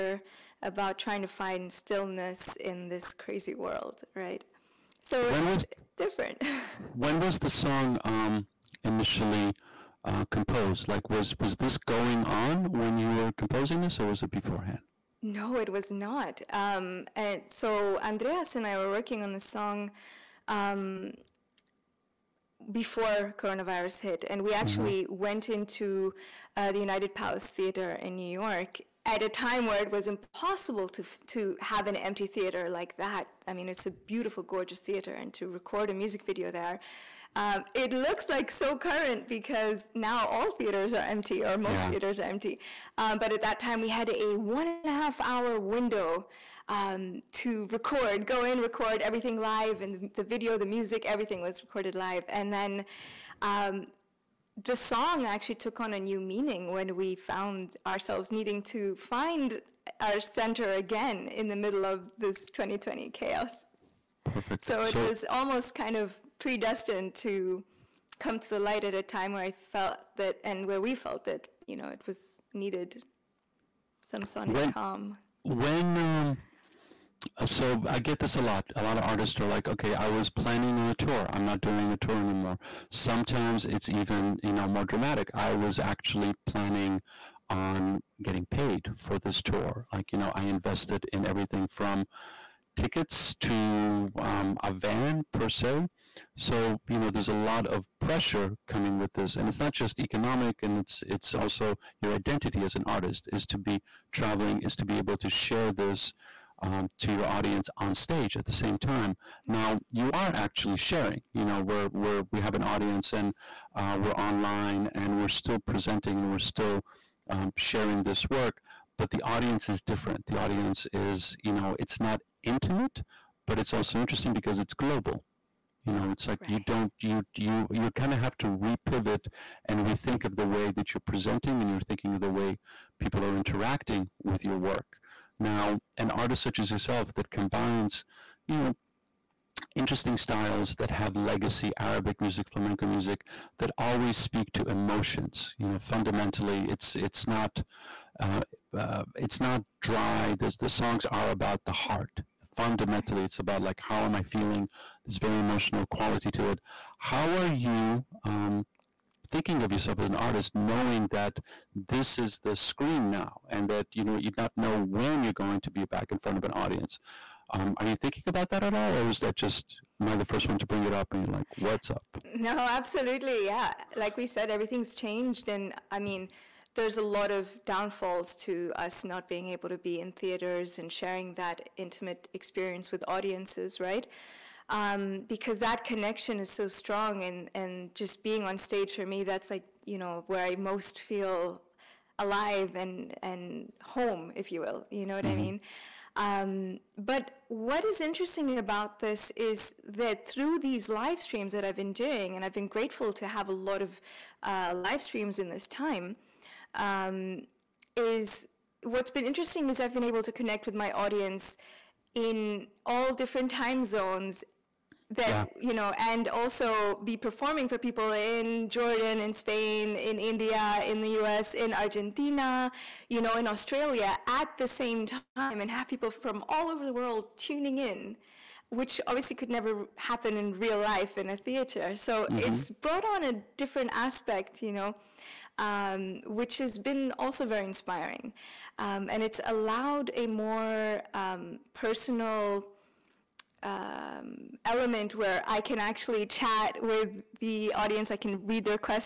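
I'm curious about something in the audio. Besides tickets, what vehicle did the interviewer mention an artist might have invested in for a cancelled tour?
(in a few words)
a van.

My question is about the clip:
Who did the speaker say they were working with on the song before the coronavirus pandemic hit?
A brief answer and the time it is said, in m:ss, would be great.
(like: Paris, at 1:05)
Andreas, at 0:18.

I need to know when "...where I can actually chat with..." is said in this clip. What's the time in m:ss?
4:05.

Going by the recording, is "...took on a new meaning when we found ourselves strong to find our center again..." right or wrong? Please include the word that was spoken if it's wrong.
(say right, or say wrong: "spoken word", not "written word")
wrong: "needing", not "strong".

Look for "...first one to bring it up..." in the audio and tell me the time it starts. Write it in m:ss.
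2:50.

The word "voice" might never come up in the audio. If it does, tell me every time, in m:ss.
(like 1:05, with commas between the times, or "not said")
not said.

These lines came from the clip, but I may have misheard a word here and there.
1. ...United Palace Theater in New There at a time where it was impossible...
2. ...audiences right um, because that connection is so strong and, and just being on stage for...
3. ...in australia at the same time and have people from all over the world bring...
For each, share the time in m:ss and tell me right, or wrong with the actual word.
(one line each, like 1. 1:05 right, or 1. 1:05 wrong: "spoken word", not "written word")
1. 0:26 wrong: "York", not "There"
2. 3:03 right
3. 3:43 wrong: "tuning", not "bring".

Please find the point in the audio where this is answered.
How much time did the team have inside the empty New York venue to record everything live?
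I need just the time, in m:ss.
0:44.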